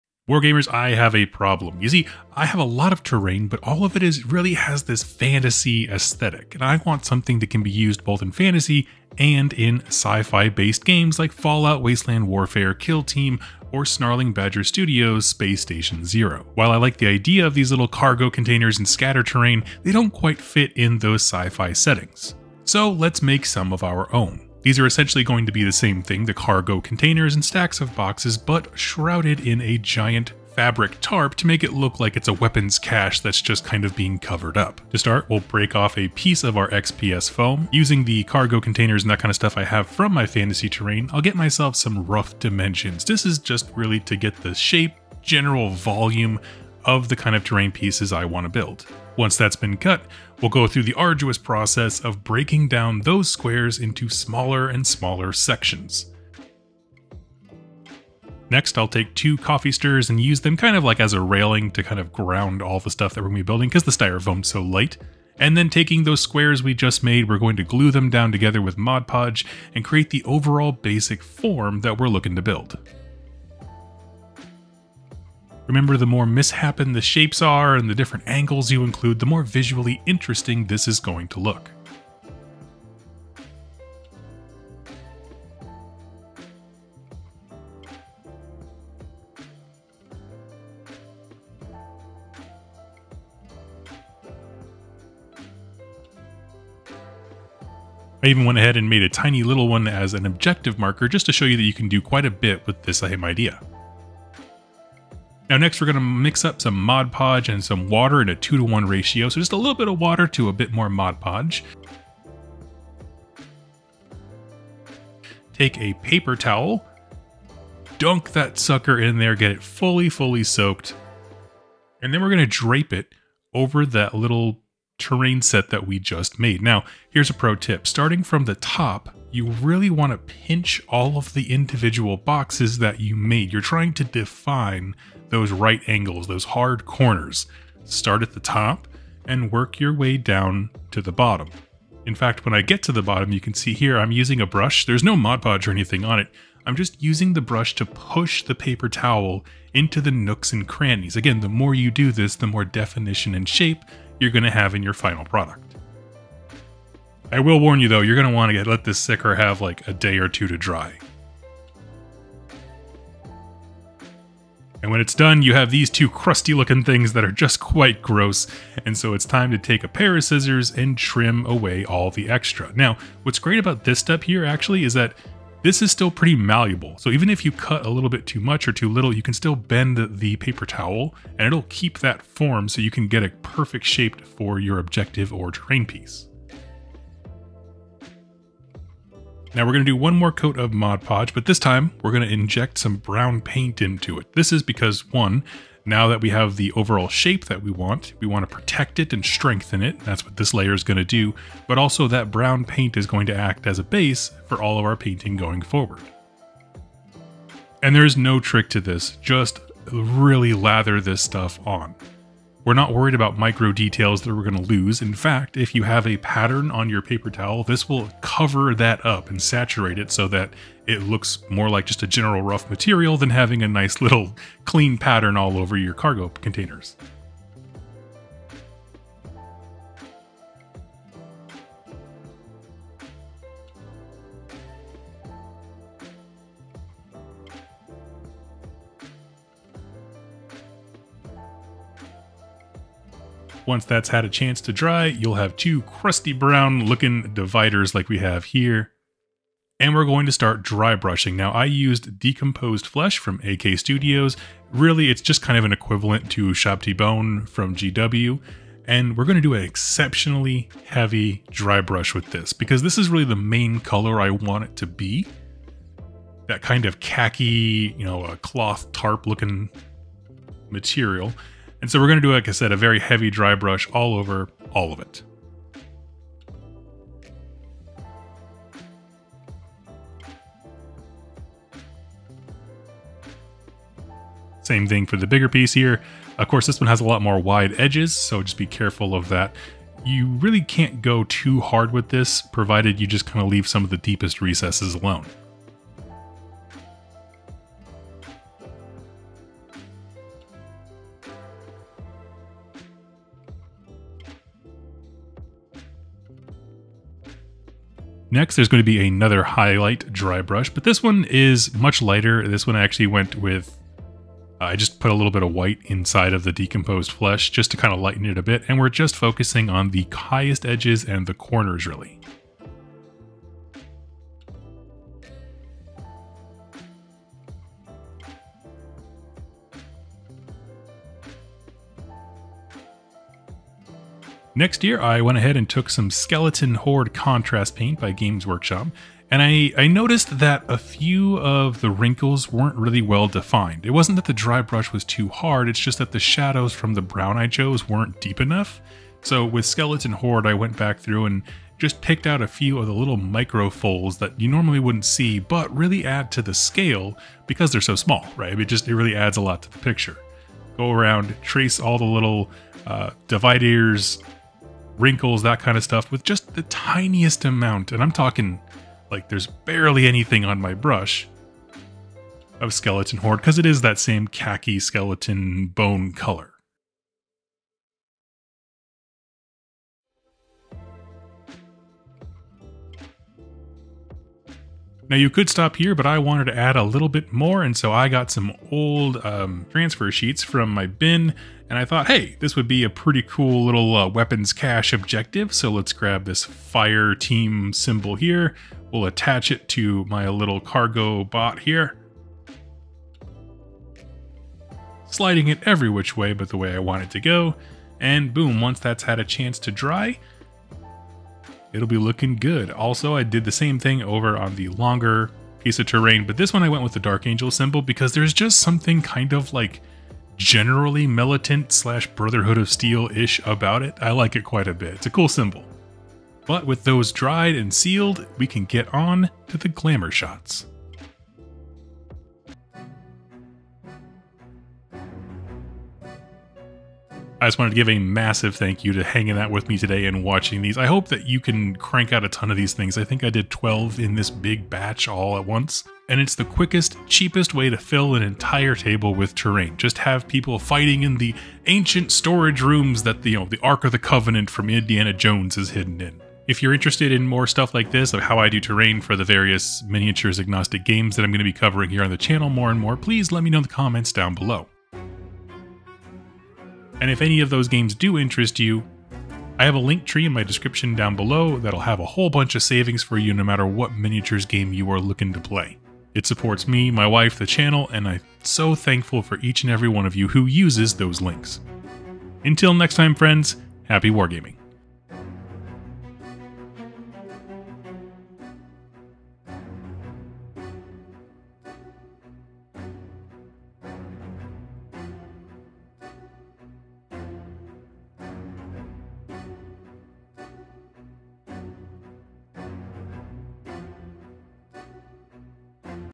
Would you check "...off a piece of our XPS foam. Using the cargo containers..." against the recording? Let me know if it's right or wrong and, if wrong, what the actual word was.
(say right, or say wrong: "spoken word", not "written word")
right.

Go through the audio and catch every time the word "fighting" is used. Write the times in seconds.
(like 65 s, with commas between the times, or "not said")
450 s.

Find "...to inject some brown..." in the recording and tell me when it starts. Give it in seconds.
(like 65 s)
192 s.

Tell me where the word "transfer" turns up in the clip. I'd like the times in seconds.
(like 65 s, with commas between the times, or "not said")
389 s.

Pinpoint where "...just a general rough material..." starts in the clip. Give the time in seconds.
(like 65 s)
221 s.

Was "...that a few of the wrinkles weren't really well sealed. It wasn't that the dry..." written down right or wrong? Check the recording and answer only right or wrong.
wrong.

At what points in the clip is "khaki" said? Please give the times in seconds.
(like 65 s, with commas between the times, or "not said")
266 s, 374 s.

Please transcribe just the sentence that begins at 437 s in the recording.
I just wanted to give a massive thank you to hanging out with me today and watching these.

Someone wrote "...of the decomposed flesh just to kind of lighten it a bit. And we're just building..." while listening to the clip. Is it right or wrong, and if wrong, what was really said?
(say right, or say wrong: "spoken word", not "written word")
wrong: "focusing", not "building".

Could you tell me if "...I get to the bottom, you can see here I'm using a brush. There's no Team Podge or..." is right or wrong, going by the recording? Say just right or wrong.
wrong.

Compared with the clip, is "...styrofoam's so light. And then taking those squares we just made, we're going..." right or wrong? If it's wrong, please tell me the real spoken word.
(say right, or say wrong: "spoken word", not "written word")
right.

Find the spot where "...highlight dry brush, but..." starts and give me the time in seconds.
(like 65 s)
309 s.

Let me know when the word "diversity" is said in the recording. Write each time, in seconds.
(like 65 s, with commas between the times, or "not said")
not said.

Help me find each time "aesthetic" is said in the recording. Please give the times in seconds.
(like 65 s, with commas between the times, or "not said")
5 s.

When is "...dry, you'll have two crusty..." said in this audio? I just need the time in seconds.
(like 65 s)
244 s.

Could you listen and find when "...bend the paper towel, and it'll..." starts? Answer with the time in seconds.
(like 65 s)
179 s.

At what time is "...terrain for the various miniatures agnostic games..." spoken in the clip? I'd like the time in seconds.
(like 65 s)
458 s.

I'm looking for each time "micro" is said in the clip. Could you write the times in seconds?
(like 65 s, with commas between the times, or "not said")
213 s, 353 s.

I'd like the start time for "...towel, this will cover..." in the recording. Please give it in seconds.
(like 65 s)
217 s.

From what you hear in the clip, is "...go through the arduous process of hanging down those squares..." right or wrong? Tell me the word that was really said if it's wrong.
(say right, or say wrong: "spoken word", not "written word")
wrong: "breaking", not "hanging".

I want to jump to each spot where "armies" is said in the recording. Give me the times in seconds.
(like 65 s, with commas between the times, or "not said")
not said.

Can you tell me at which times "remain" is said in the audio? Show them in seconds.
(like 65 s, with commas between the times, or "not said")
not said.